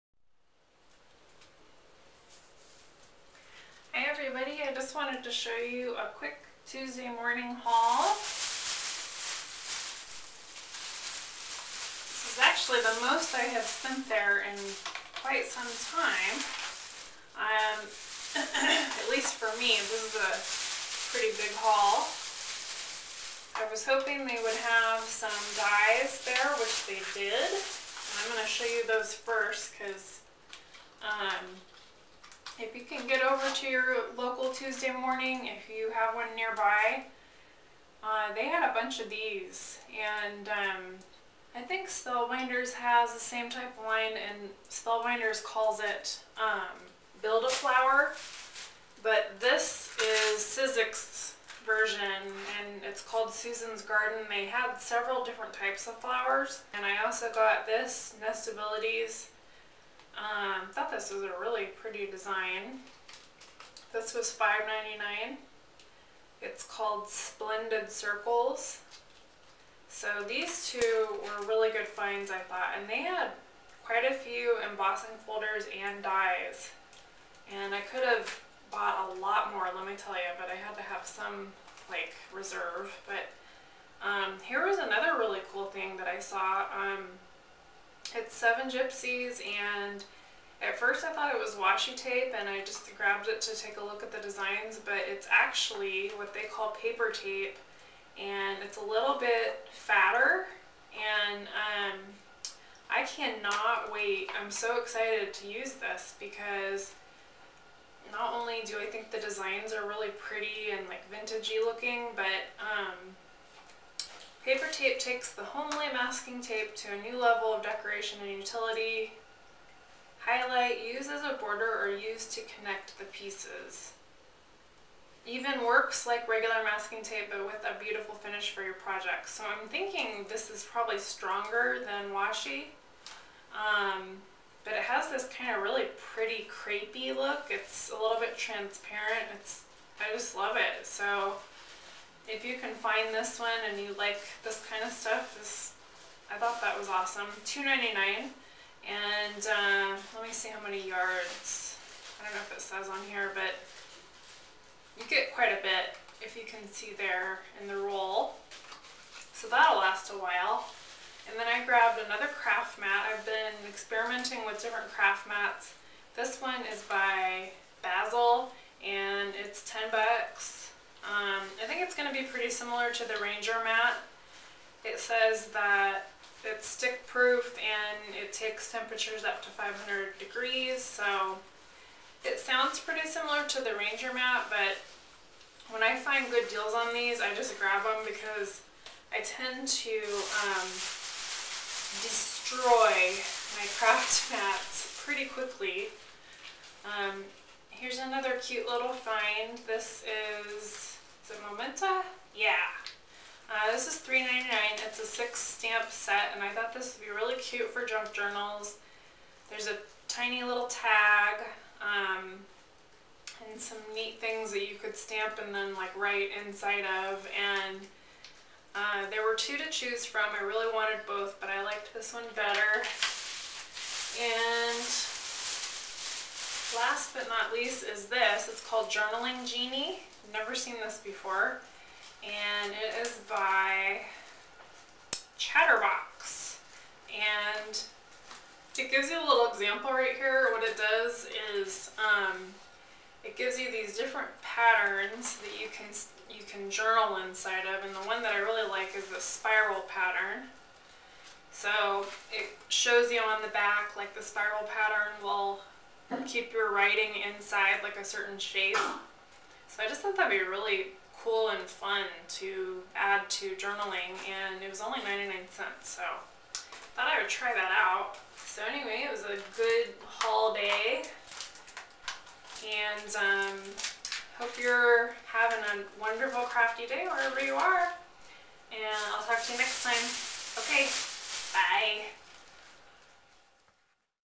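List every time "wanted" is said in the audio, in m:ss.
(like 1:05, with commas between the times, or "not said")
0:04, 3:40.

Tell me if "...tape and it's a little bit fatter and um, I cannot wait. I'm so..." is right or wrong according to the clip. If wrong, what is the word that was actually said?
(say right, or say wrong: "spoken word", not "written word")
right.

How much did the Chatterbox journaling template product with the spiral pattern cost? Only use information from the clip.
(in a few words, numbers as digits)
99 cents.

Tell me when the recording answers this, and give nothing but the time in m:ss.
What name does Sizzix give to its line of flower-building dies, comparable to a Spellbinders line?
0:53.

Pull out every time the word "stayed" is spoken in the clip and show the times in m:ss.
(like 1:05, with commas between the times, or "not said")
not said.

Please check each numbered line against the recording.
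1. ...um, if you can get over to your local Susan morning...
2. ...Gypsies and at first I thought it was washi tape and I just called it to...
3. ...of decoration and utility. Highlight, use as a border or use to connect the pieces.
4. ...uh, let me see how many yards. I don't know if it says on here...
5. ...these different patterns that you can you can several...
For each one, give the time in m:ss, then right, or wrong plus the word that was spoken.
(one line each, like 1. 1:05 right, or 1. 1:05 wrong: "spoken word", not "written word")
1. 0:31 wrong: "Tuesday", not "Susan"
2. 1:28 wrong: "grabbed", not "called"
3. 1:57 right
4. 2:29 right
5. 4:03 wrong: "journal", not "several".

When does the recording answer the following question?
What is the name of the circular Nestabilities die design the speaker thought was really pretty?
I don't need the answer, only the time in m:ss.
1:07.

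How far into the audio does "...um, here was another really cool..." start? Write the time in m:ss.
1:24.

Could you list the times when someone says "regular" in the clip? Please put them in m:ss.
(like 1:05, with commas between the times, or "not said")
2:06.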